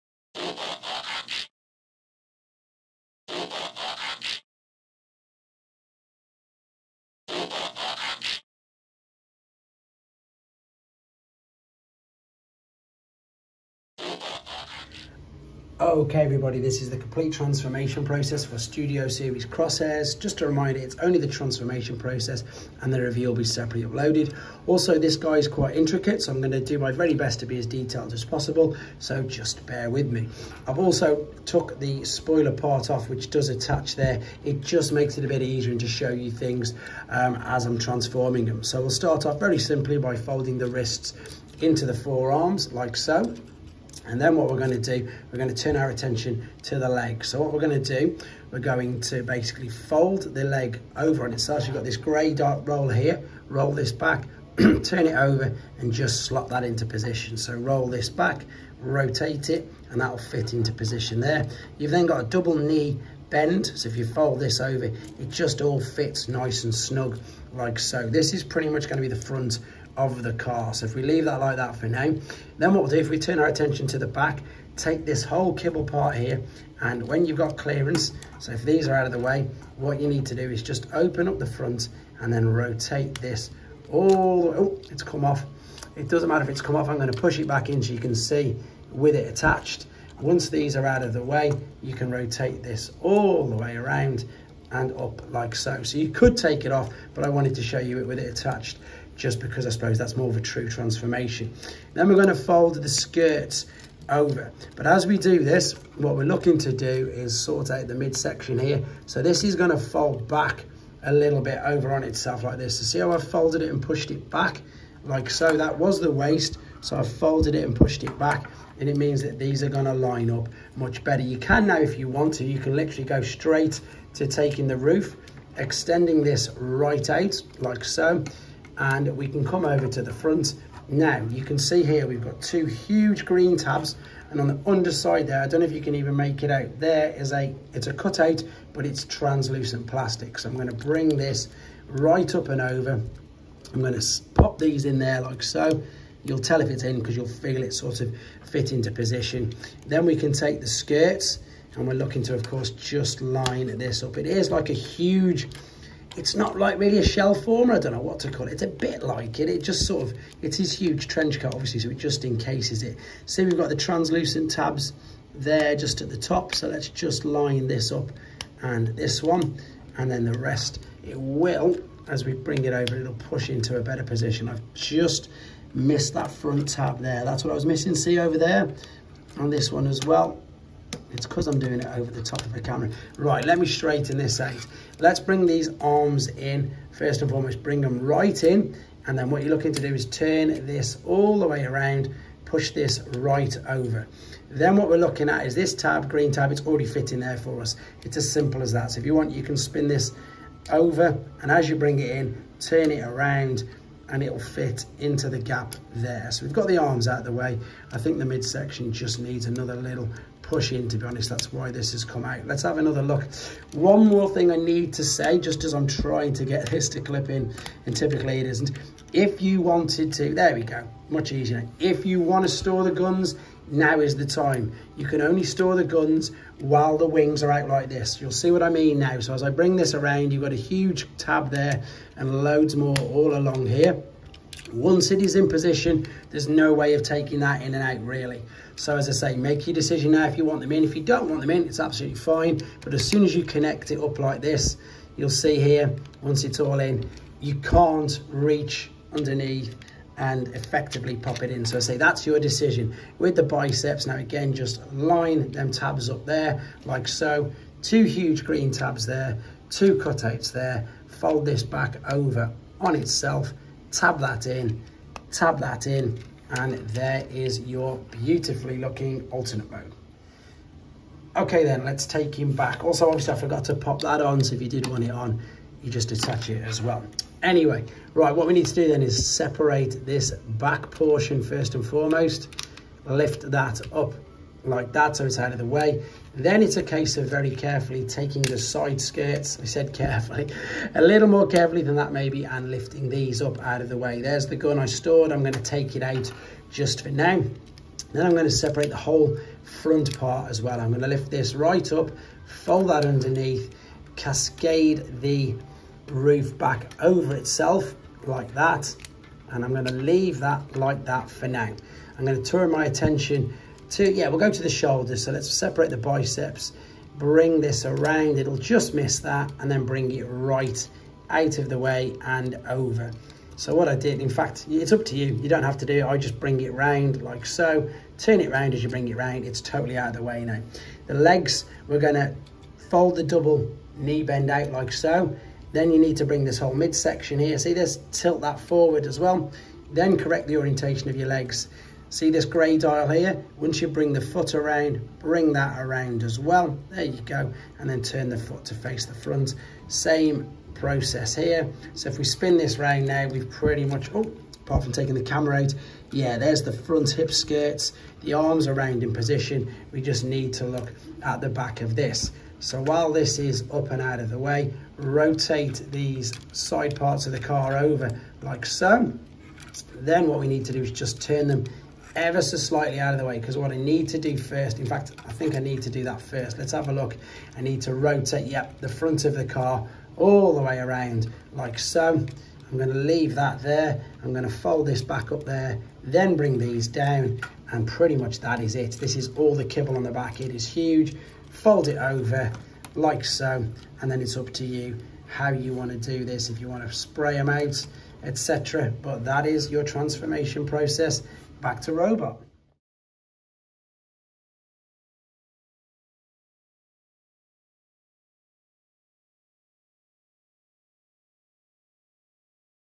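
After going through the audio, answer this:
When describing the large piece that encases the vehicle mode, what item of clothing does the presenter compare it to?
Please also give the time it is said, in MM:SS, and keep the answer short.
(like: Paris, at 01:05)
trench coat, at 02:41.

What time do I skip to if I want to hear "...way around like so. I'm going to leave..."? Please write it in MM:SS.
06:20.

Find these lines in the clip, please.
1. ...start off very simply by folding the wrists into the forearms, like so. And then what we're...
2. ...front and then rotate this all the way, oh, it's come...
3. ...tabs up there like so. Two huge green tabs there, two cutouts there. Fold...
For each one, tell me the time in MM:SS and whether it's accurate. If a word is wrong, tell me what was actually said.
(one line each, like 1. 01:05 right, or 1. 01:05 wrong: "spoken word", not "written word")
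1. 00:38 right
2. 01:21 right
3. 04:15 right.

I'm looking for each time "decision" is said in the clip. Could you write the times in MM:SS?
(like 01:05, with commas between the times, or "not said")
03:59, 04:12.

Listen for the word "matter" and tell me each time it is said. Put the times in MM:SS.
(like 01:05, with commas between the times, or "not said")
01:26.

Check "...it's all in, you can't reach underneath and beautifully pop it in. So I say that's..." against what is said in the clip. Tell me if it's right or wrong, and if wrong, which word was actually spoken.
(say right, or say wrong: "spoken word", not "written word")
wrong: "effectively", not "beautifully".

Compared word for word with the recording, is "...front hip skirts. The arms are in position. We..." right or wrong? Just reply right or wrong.
right.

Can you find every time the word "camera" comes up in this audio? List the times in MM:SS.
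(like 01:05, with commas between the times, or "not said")
03:02, 05:55.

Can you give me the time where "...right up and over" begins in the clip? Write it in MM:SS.
02:21.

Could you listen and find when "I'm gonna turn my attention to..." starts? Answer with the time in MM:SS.
05:12.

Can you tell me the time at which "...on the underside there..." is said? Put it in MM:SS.
02:14.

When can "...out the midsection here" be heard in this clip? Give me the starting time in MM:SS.
01:47.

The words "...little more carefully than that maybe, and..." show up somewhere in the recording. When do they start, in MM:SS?
04:51.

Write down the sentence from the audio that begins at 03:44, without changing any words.
You can only store the guns while the wings are out like this.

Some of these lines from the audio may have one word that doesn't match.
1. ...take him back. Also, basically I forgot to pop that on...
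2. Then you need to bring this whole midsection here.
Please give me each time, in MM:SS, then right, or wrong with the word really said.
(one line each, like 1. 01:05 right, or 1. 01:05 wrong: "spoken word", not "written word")
1. 04:32 wrong: "obviously", not "basically"
2. 05:35 right.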